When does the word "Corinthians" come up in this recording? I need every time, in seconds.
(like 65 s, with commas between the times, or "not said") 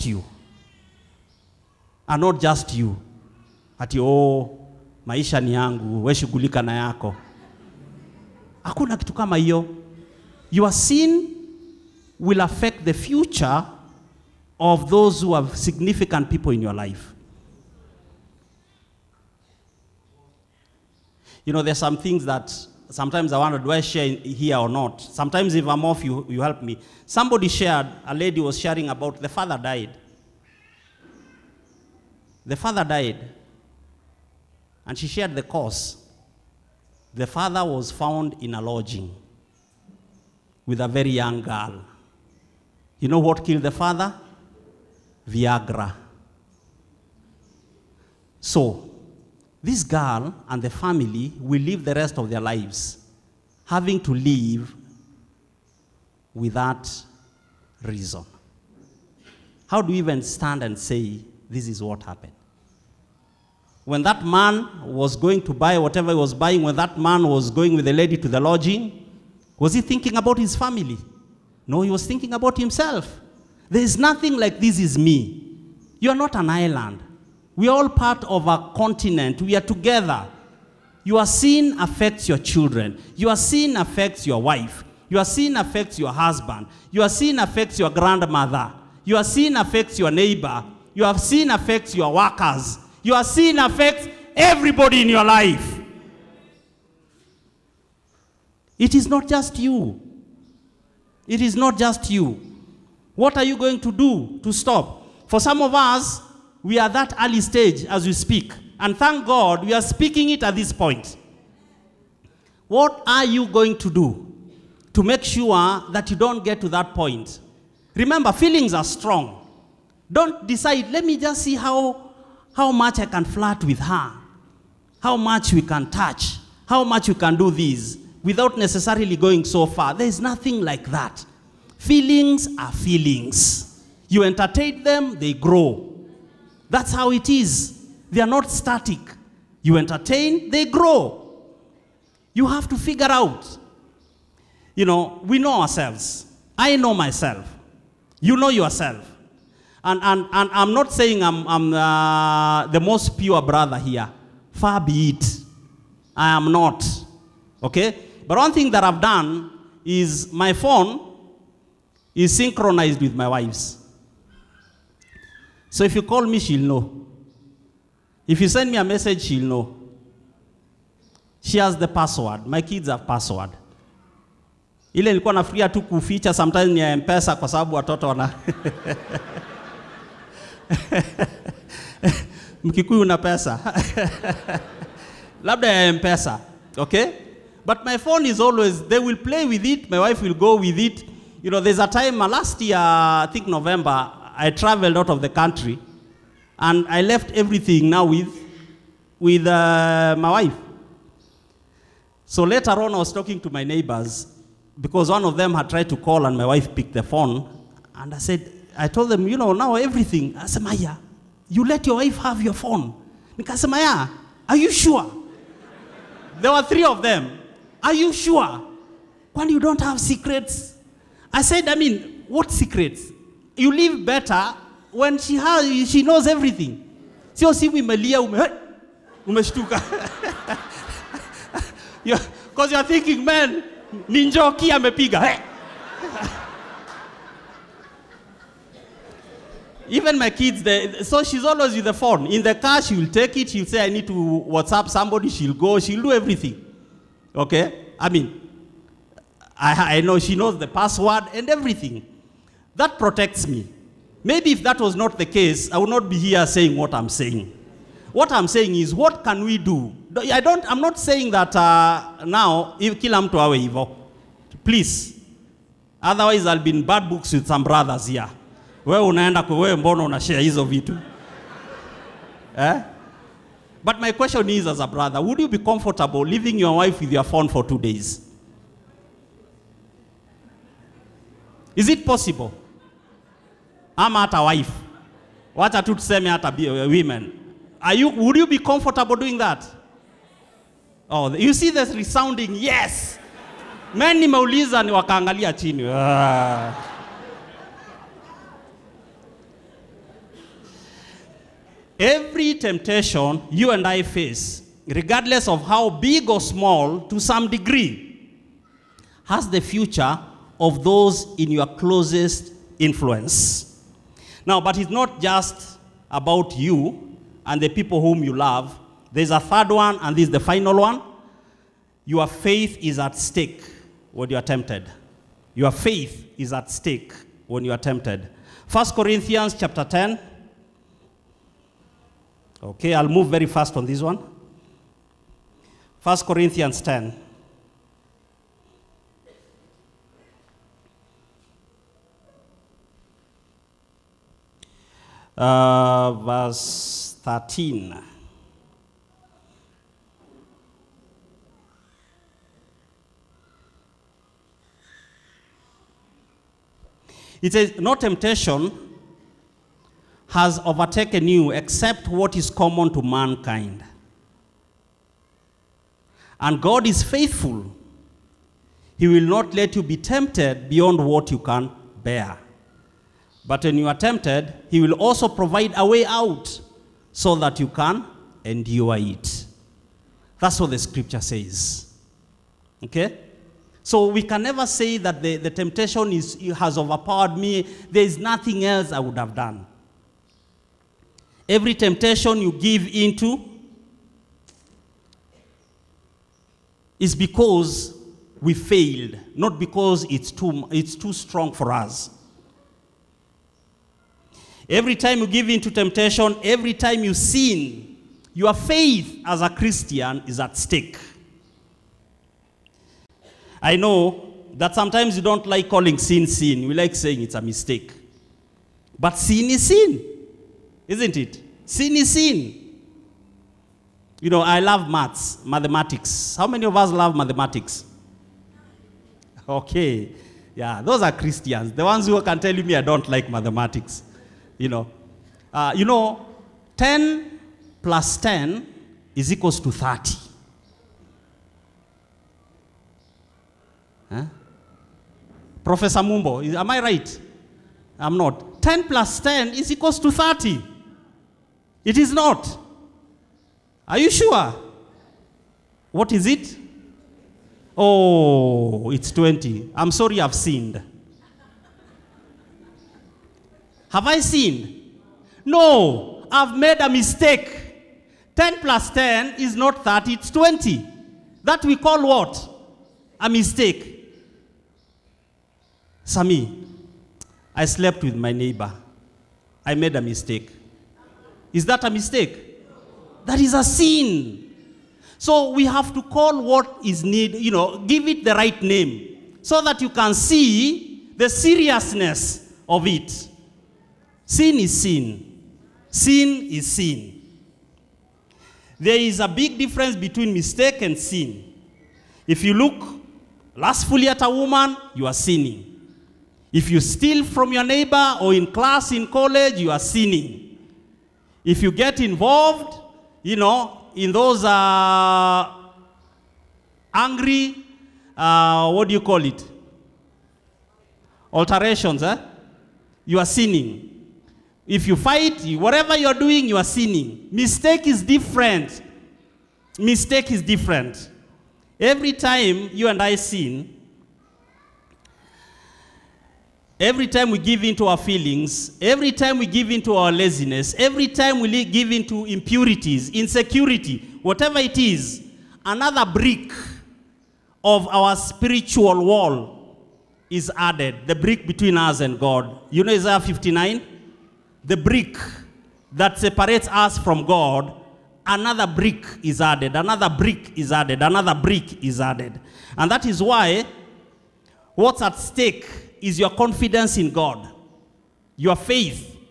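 328 s, 336 s.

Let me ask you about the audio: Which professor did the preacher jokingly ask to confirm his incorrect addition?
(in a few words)
Professor Mumbo.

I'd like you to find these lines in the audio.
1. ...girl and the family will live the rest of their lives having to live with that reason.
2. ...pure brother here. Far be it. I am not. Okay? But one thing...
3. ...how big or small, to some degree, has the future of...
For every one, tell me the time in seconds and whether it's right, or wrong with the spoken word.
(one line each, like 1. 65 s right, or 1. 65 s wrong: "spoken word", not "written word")
1. 49 s right
2. 153 s right
3. 305 s right.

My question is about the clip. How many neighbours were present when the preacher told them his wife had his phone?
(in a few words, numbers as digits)
3.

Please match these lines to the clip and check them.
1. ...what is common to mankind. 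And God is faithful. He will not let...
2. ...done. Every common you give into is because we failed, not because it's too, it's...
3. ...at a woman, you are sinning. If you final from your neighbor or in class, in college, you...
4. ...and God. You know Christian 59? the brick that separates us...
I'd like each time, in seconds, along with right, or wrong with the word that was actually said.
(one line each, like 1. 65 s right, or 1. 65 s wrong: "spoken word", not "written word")
1. 362 s right
2. 389 s wrong: "temptation", not "common"
3. 504 s wrong: "steal", not "final"
4. 551 s wrong: "Isaiah", not "Christian".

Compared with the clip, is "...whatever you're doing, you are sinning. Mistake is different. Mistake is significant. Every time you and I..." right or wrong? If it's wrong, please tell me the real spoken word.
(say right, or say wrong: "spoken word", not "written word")
wrong: "different", not "significant".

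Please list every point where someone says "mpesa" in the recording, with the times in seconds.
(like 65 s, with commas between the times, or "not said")
176 s, 185 s.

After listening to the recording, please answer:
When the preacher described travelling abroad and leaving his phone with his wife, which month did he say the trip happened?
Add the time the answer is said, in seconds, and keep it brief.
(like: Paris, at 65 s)
November, at 193 s.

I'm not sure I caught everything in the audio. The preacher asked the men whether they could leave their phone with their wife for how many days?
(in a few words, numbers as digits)
2.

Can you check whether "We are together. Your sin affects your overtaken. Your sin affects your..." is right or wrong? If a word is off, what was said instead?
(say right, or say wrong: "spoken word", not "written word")
wrong: "children", not "overtaken".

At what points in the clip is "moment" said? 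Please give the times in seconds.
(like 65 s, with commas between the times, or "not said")
not said.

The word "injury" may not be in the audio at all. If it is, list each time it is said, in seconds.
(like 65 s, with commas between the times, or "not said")
not said.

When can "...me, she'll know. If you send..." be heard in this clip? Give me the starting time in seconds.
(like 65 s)
166 s.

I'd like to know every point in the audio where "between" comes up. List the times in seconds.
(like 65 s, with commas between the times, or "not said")
499 s, 551 s.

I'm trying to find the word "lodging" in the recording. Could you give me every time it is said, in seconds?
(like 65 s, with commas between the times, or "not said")
38 s, 68 s.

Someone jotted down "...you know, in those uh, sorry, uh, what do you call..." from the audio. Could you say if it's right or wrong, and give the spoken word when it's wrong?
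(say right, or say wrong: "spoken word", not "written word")
wrong: "angry", not "sorry".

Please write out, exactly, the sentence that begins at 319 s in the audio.
There's a third one, and this is the final one.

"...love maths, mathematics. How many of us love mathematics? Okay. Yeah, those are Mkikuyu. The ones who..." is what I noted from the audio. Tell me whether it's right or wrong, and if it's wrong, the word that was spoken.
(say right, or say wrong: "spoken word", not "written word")
wrong: "Christians", not "Mkikuyu".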